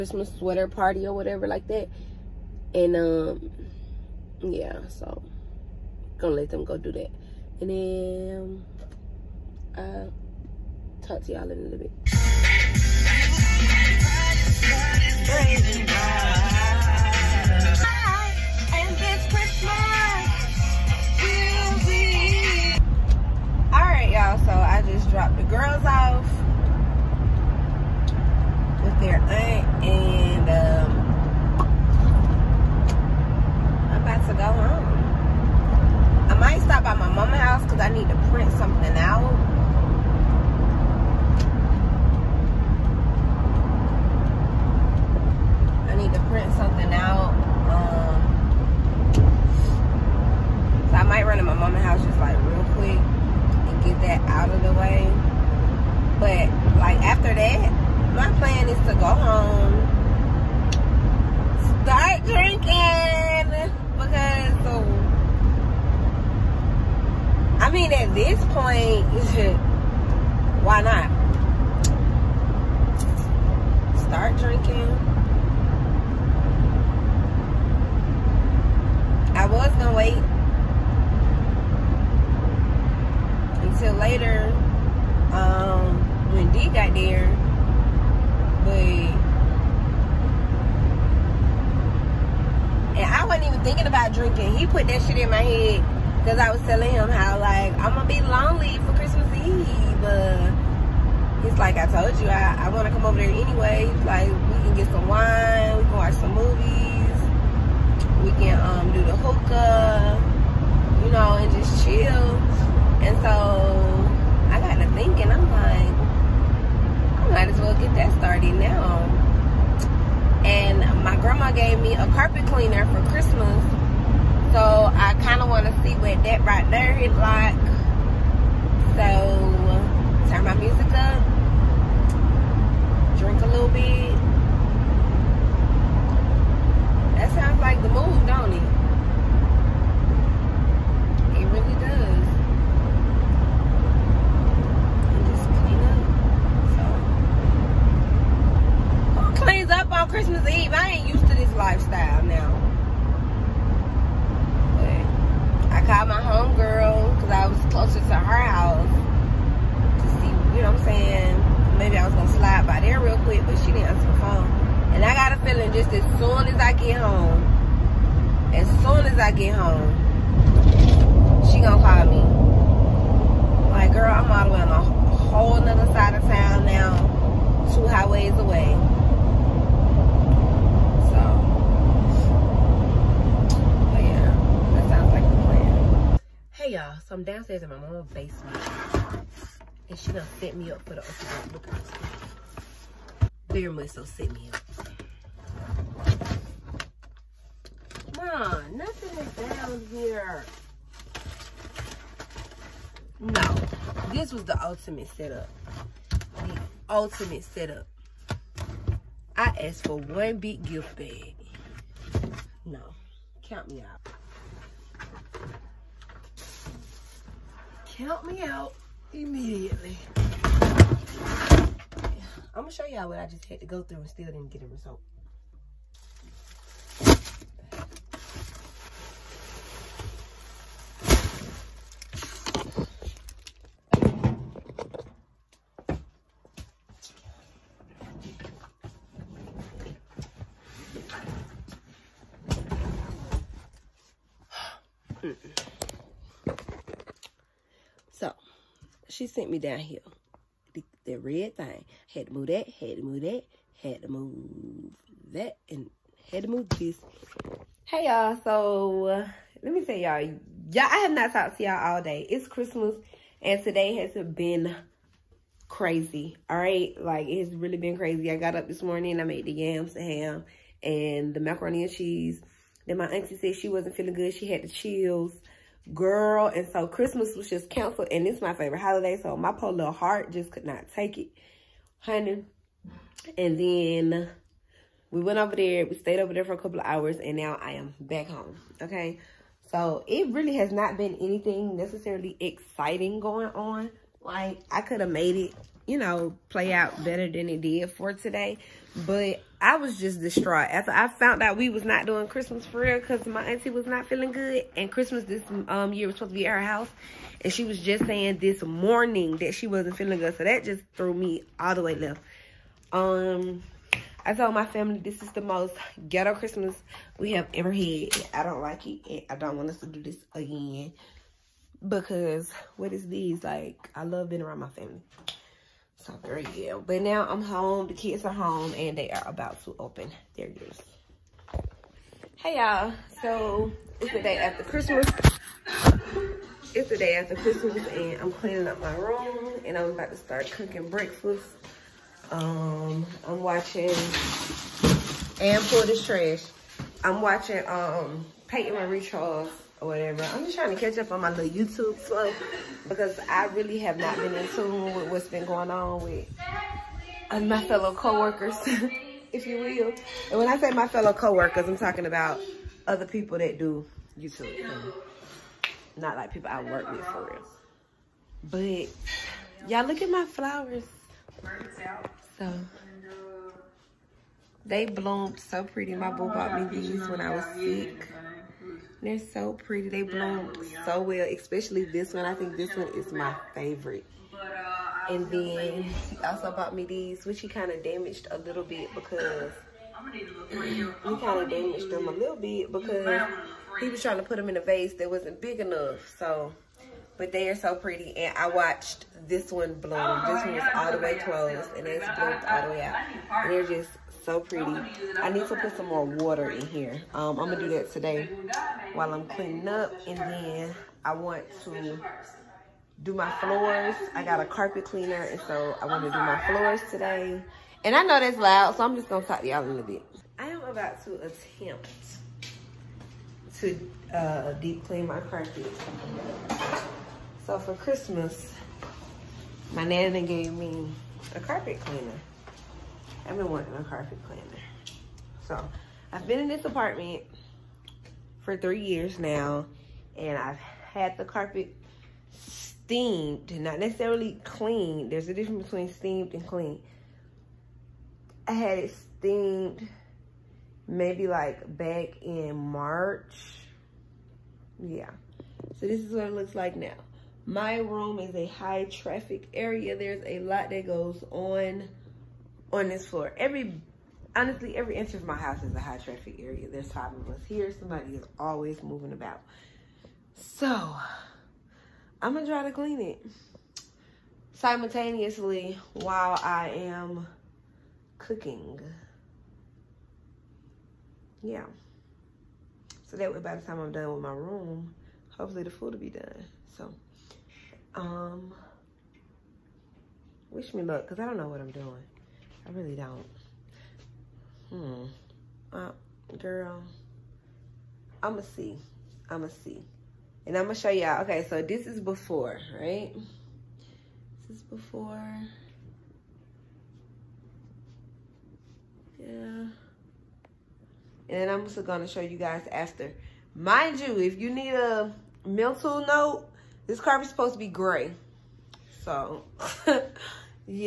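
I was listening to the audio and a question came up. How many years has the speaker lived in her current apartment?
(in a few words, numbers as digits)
3.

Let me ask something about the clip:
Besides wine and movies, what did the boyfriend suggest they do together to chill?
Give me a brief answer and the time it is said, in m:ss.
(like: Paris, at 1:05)
the hookah, at 1:49.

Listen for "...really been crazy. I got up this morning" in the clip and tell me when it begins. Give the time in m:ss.
4:27.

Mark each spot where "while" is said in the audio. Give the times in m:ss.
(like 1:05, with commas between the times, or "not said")
6:48, 7:55.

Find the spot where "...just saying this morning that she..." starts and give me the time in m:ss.
5:07.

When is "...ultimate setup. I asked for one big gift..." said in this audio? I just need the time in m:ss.
3:26.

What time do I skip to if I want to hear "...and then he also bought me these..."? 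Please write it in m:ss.
6:25.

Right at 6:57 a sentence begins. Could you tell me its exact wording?
And I know that's loud, so I'm just gonna talk to y'all a little bit.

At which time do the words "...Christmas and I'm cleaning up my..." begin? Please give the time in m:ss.
5:37.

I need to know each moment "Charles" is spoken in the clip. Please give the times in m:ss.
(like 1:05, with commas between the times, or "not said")
5:48.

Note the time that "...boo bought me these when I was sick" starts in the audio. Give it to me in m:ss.
6:16.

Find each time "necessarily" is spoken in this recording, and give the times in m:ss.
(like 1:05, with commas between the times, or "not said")
4:51, 7:23.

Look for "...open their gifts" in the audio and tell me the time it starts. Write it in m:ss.
5:29.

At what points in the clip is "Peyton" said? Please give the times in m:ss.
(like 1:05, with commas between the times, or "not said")
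5:48.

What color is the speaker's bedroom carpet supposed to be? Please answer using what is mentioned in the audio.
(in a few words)
gray.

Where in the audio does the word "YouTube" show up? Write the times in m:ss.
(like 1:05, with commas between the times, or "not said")
5:51, 6:04.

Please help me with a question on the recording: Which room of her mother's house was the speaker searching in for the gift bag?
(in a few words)
basement.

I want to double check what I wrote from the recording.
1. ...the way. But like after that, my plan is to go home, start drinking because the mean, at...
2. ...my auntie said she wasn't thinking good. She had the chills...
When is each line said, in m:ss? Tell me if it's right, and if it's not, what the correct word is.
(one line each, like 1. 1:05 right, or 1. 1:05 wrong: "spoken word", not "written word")
1. 0:54 right
2. 4:32 wrong: "feeling", not "thinking".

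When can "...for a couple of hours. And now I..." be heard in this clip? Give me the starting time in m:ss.
4:46.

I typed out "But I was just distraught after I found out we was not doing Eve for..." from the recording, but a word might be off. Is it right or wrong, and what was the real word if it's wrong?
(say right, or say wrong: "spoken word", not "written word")
wrong: "Christmas", not "Eve".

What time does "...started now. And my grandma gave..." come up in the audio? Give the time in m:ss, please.
1:58.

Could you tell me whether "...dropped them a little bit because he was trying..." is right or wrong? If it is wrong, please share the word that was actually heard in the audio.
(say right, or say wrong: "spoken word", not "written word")
wrong: "damaged", not "dropped".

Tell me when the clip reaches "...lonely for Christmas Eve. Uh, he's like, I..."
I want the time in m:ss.
1:38.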